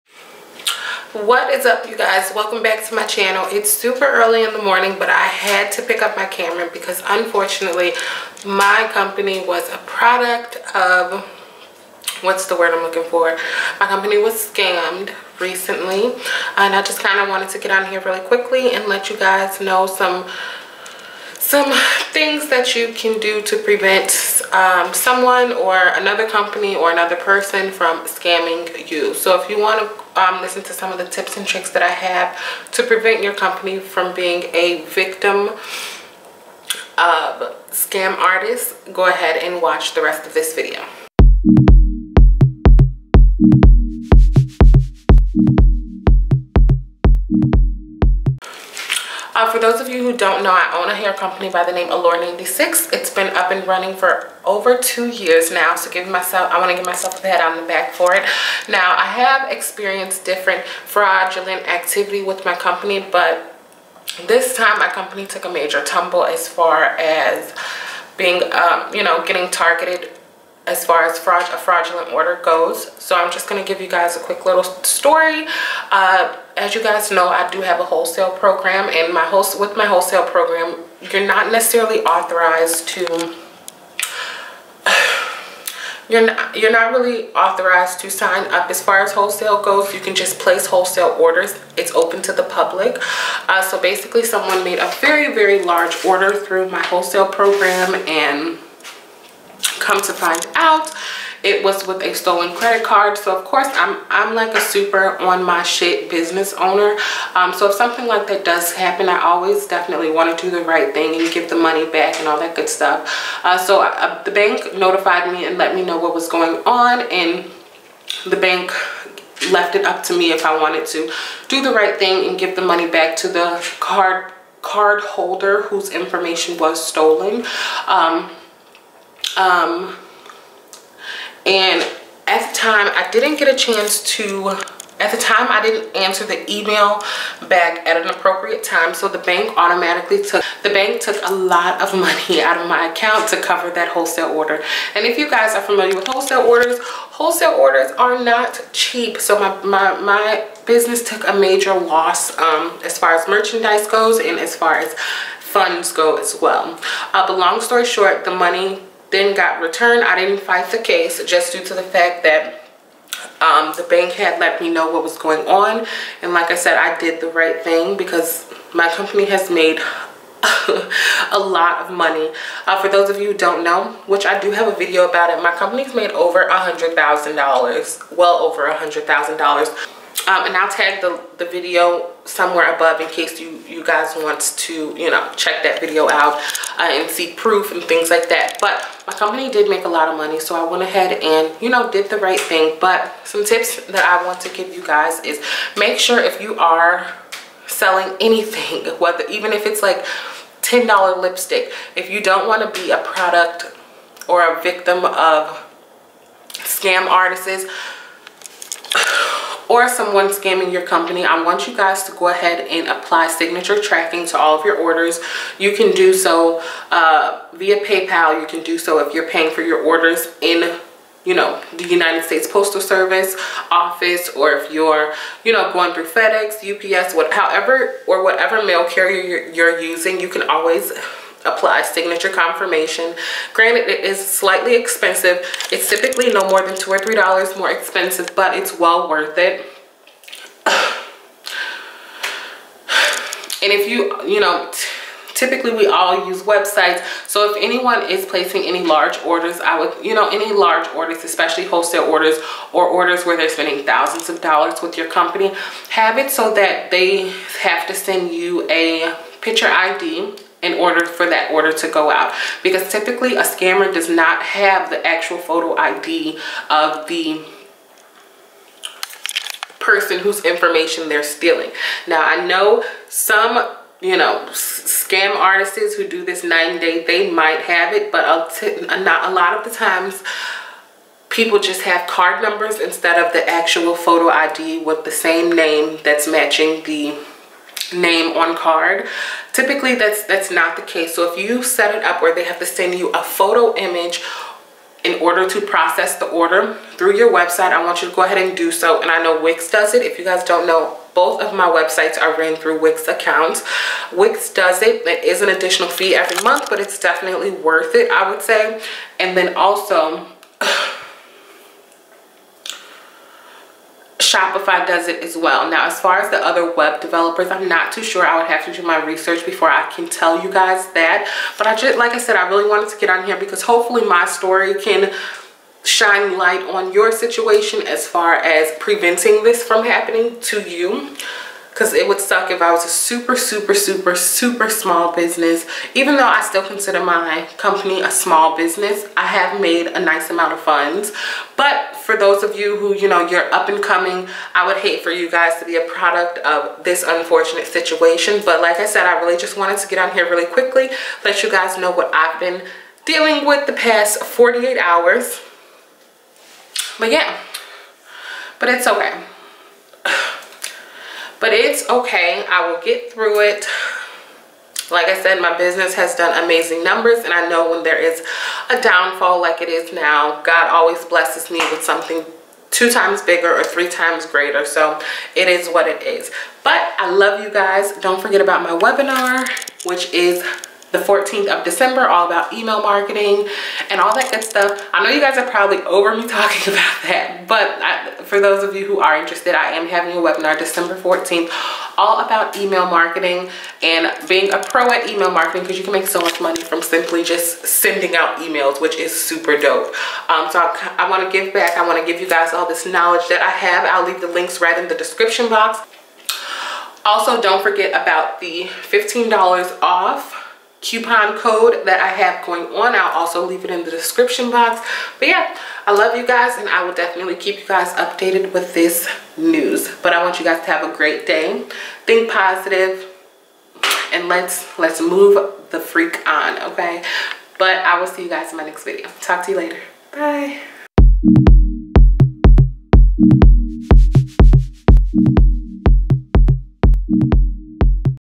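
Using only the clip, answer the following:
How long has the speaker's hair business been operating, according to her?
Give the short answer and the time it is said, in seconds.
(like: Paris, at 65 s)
over two years, at 54 s.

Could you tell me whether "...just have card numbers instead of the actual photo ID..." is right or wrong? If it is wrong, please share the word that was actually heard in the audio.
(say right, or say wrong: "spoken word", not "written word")
right.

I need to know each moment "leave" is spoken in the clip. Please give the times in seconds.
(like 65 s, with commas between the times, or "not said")
404 s, 413 s.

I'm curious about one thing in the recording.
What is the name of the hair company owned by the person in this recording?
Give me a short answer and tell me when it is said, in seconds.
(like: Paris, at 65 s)
Allure 96, at 51 s.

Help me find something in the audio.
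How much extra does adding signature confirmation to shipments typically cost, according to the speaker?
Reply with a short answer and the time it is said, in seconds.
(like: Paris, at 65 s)
2 or 3 dollars, at 236 s.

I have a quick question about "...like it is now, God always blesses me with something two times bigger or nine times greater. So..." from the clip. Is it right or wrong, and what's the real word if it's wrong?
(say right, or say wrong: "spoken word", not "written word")
wrong: "three", not "nine".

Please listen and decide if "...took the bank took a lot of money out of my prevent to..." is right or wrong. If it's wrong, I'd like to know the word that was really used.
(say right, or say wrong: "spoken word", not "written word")
wrong: "account", not "prevent".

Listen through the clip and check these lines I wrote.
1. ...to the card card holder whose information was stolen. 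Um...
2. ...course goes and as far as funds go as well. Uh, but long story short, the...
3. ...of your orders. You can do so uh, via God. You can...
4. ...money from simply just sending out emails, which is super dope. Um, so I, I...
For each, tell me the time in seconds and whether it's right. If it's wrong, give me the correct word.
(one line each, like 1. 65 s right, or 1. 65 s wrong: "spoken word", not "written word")
1. 123 s right
2. 153 s wrong: "merchandise", not "course"
3. 214 s wrong: "PayPal", not "God"
4. 396 s right.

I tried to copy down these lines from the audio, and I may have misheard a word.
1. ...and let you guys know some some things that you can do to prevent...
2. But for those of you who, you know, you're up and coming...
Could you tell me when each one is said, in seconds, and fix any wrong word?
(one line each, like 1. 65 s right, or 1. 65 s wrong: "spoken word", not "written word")
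1. 18 s right
2. 341 s right.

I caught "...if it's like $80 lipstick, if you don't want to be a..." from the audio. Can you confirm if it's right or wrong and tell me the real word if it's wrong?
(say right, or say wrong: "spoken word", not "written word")
wrong: "10", not "80".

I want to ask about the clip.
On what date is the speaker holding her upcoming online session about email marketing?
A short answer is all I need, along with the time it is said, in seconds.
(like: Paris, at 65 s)
December 14th, at 390 s.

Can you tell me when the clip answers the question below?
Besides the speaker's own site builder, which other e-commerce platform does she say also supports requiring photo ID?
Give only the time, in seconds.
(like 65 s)
314 s.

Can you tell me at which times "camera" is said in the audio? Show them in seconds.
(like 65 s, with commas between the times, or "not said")
6 s.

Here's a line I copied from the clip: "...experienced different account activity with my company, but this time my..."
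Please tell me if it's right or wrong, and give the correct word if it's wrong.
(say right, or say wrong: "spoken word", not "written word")
wrong: "fraudulent", not "account".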